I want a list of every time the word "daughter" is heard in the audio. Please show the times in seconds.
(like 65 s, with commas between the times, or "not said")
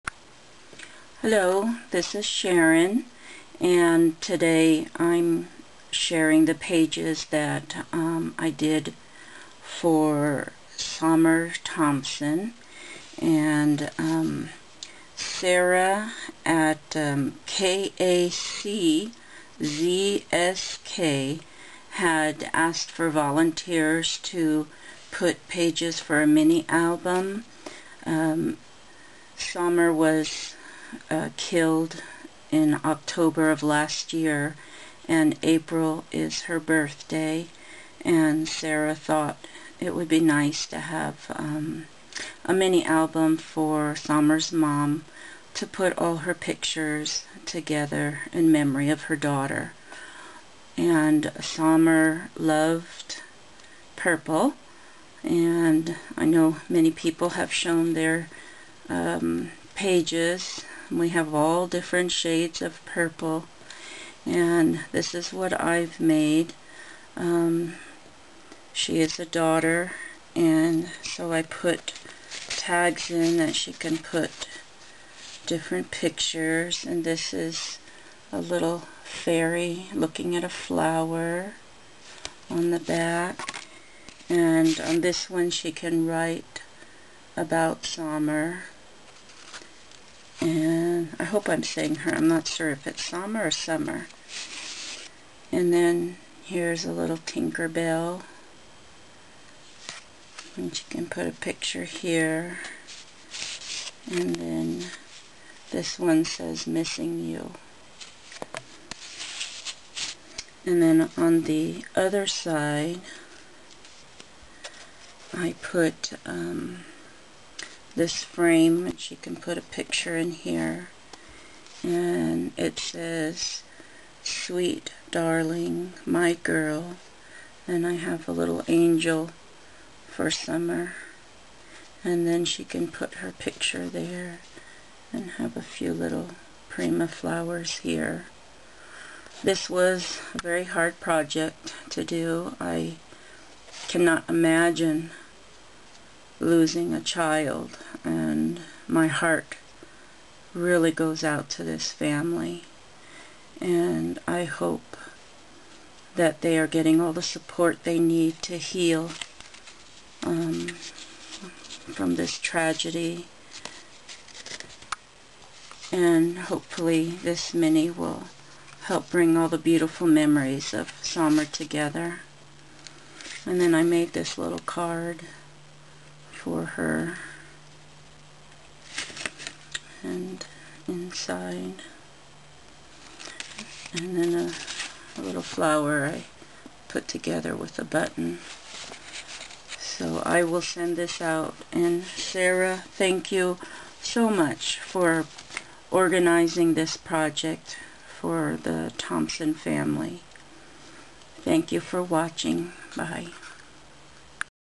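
49 s, 69 s.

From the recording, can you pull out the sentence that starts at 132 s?
And then she can put her picture there and have a few little prima flowers here.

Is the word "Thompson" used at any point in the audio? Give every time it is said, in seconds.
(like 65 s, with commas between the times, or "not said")
11 s, 198 s.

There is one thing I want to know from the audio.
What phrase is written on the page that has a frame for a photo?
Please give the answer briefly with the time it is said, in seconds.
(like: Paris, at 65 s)
Sweet darling, my girl, at 124 s.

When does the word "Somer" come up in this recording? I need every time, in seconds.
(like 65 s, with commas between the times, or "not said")
10 s, 29 s, 43 s, 87 s, 130 s, 171 s.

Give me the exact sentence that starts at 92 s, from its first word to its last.
I'm not sure if it's summer or summer.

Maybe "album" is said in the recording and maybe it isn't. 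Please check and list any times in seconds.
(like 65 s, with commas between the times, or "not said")
26 s, 42 s.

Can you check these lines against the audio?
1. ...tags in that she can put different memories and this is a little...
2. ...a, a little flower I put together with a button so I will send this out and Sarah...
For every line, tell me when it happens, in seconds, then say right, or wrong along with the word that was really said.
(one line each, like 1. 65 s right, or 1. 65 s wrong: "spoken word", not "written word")
1. 72 s wrong: "pictures", not "memories"
2. 184 s right.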